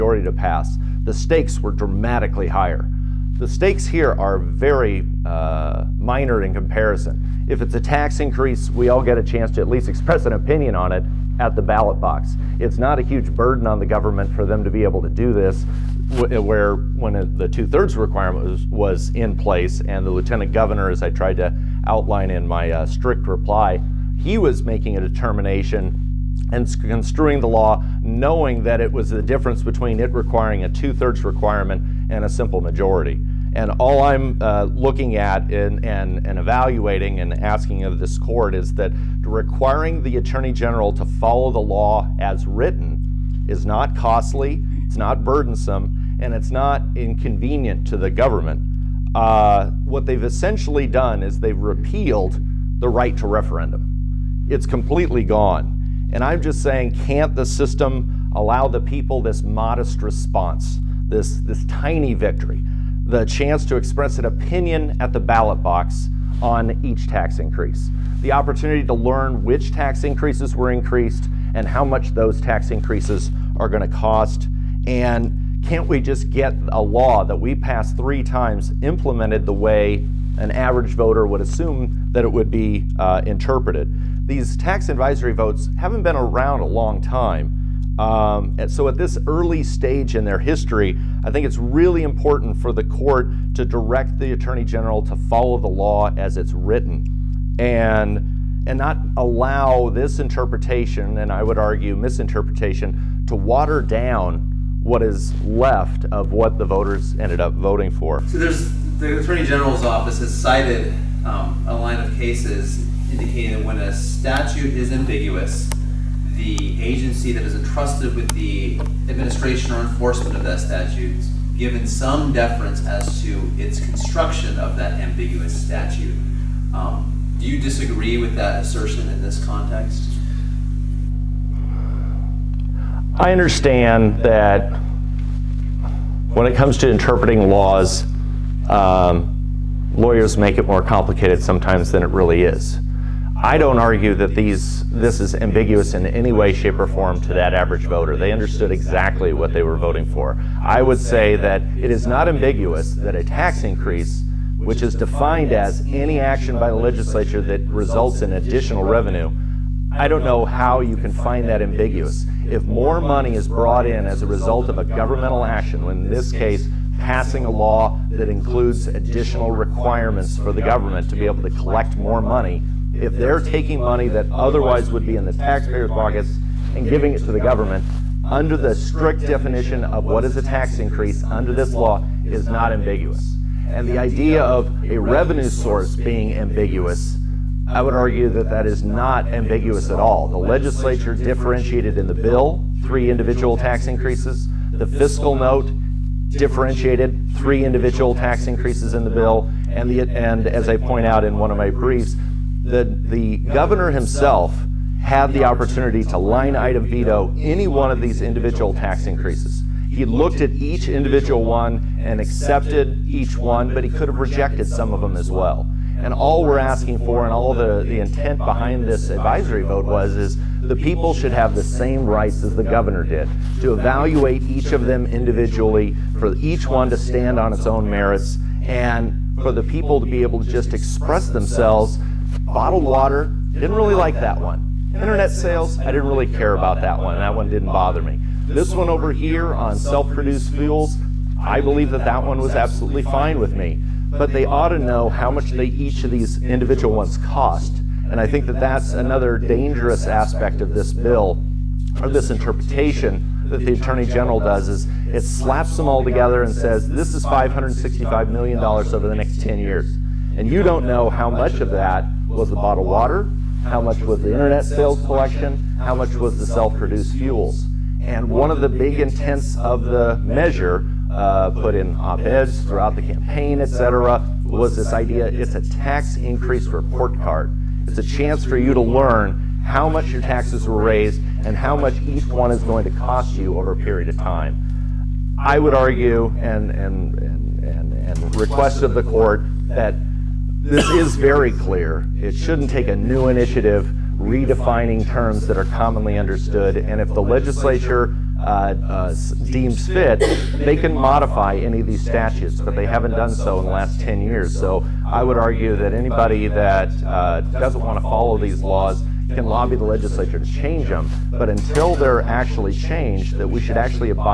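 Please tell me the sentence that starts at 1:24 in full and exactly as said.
These tax advisory votes haven't been around a long time.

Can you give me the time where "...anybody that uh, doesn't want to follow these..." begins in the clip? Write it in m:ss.
5:05.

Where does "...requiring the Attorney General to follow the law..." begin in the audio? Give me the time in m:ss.
0:39.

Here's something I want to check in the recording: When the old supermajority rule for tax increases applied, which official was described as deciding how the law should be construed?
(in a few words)
lieutenant governor.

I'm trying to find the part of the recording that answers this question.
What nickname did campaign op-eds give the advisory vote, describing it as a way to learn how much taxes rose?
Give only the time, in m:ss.
4:35.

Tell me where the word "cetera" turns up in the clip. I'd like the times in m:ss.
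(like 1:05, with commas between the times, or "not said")
4:33.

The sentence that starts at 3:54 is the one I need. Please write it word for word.
Internet sales, I didn't really care about that one.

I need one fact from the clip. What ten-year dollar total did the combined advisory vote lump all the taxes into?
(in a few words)
$565 million.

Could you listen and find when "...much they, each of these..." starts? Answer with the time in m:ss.
4:05.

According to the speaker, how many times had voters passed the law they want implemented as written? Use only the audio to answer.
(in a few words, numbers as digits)
3.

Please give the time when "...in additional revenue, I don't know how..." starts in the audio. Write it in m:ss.
2:38.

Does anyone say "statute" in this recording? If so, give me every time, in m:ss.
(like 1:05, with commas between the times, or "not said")
1:53, 2:00, 2:05, 5:01.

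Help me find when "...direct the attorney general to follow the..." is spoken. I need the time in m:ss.
1:33.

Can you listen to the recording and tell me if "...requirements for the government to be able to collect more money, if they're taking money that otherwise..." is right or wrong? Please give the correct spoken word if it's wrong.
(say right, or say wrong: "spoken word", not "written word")
right.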